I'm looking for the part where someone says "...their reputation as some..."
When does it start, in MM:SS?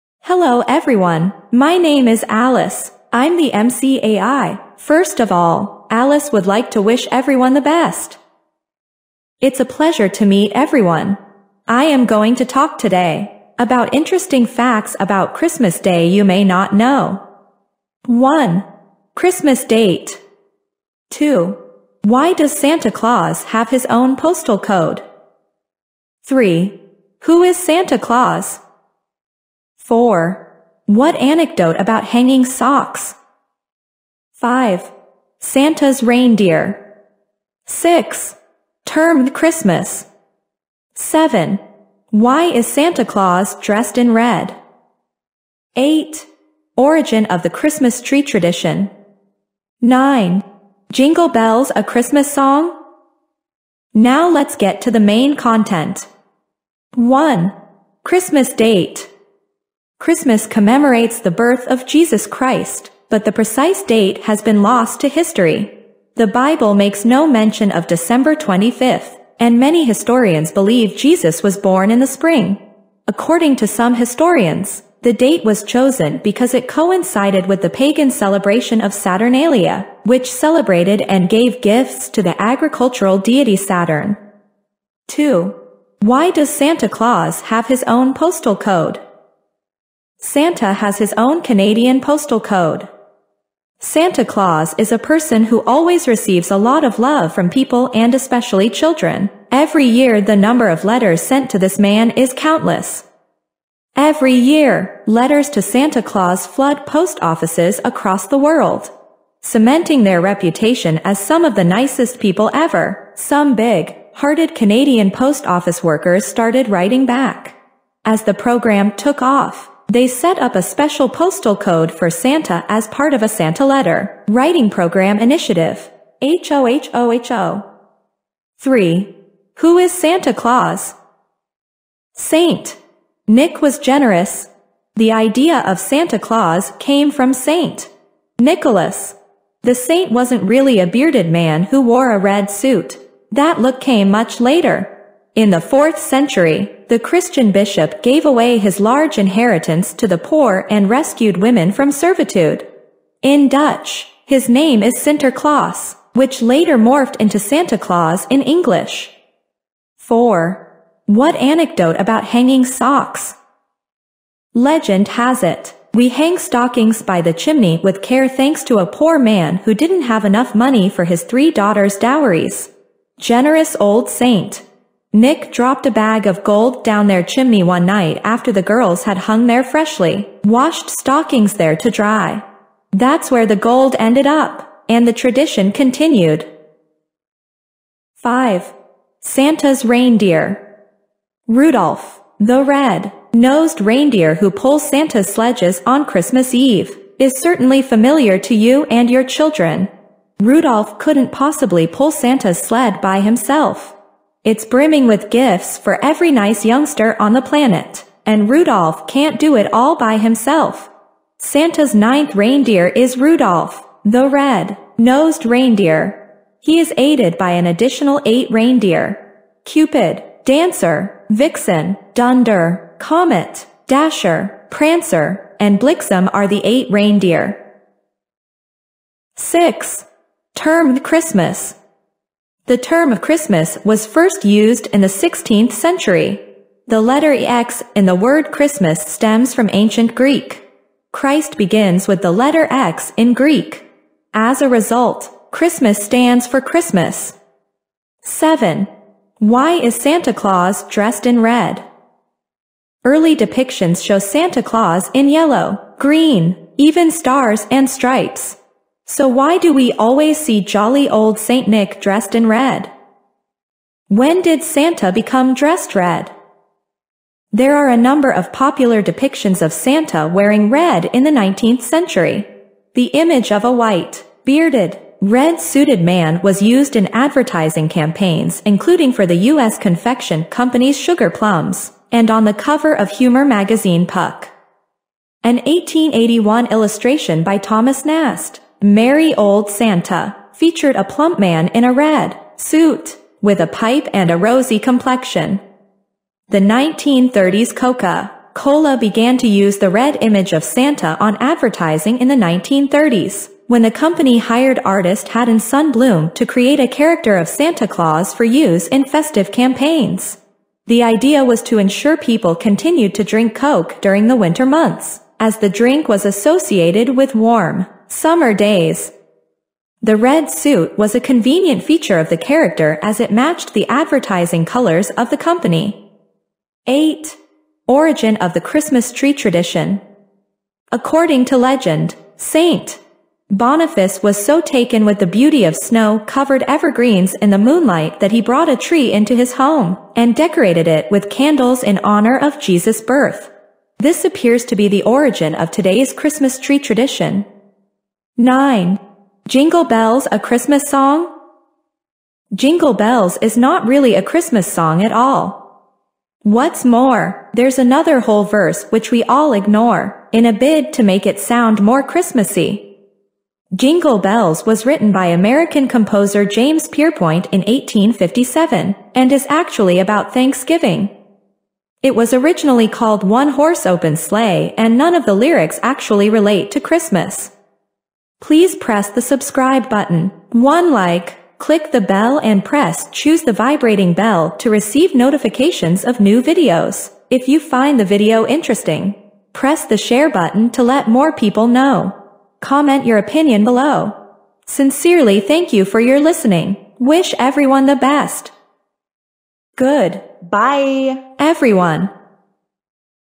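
01:50.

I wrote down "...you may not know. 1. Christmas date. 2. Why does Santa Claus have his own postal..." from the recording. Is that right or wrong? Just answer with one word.
right.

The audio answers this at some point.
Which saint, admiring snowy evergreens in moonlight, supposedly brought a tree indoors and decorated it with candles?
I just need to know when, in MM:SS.
05:32.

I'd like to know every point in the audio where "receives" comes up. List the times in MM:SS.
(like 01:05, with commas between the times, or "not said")
01:36, 06:24.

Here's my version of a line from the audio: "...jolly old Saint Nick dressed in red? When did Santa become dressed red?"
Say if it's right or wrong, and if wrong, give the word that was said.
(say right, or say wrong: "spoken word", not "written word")
right.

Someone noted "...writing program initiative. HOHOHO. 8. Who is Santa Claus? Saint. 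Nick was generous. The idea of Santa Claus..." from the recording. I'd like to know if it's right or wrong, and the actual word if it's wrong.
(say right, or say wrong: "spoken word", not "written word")
wrong: "3", not "8".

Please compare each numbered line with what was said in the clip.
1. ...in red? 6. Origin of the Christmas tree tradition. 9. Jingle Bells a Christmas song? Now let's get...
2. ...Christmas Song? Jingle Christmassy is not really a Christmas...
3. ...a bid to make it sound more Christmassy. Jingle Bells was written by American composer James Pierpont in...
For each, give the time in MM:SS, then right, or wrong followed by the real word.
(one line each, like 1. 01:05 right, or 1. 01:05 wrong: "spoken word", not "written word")
1. 00:43 wrong: "8", not "6"
2. 05:50 wrong: "Bells", not "Christmassy"
3. 06:00 right.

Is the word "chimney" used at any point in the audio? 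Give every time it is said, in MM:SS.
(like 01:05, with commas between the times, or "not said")
02:47, 02:57.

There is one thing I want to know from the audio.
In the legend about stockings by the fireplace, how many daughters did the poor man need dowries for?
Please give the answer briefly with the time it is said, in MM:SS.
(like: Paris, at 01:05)
3, at 02:51.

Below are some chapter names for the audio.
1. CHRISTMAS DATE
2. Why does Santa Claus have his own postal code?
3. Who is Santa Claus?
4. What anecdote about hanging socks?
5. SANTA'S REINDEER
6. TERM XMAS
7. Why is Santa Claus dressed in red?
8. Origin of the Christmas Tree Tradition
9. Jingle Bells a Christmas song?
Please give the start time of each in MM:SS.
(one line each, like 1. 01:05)
1. 00:57
2. 01:25
3. 02:07
4. 02:40
5. 03:09
6. 03:49
7. 04:09
8. 05:26
9. 05:47.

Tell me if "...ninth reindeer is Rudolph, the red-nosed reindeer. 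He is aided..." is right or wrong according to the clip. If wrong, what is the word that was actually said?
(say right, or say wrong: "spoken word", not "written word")
right.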